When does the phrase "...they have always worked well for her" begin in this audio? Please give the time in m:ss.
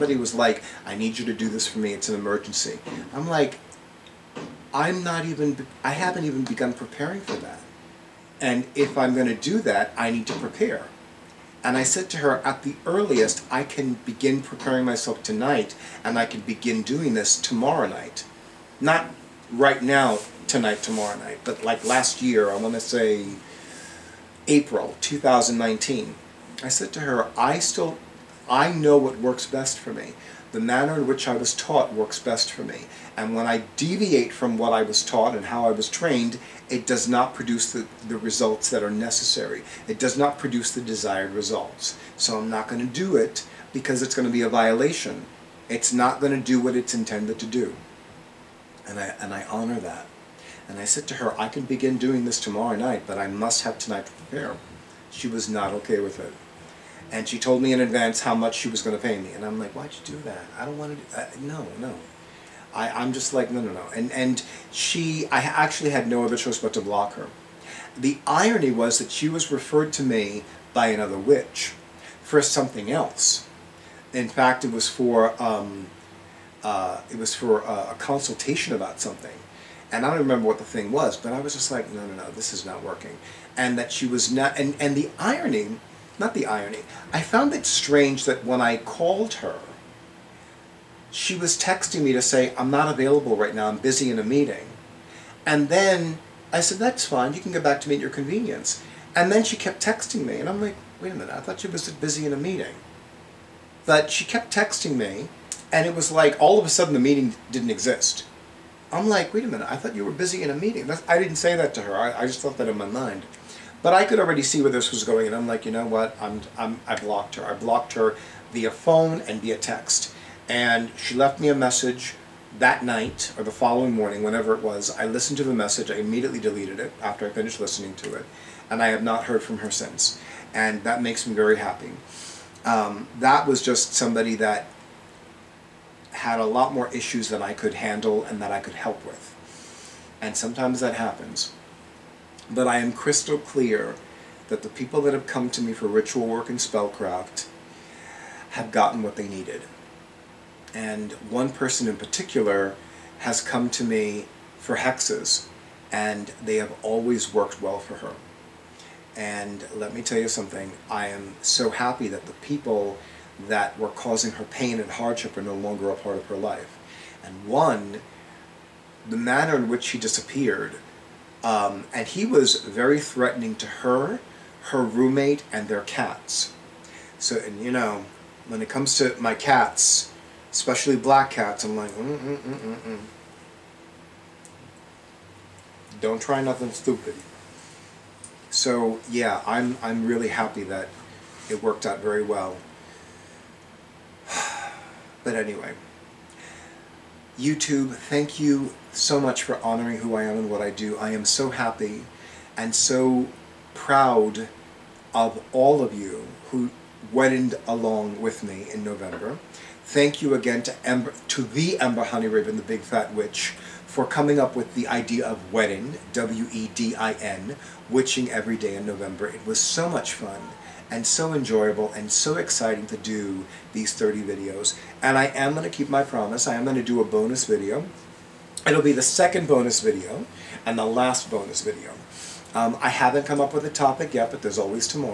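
2:36.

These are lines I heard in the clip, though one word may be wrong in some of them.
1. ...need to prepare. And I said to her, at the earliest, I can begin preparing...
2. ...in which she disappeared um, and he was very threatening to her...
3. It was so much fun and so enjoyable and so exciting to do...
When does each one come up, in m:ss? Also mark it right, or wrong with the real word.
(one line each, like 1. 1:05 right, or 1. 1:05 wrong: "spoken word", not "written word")
1. 0:10 right
2. 2:49 right
3. 3:39 right.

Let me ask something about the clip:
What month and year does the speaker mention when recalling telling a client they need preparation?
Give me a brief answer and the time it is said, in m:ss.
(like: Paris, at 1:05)
April 2019, at 0:24.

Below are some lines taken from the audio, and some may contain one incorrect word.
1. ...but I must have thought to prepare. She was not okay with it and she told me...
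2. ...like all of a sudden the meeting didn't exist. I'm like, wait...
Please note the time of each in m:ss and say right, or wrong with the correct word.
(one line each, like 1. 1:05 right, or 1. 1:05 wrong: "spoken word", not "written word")
1. 0:53 wrong: "tonight", not "thought"
2. 1:46 right.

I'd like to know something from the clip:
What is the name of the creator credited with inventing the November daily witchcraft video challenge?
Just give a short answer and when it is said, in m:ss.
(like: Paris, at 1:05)
Ember HoneyRaven, at 3:31.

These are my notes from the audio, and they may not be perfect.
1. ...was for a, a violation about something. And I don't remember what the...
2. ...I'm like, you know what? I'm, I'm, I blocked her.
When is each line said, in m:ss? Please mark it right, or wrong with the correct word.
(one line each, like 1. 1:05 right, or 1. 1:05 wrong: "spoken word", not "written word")
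1. 1:17 wrong: "consultation", not "violation"
2. 1:55 right.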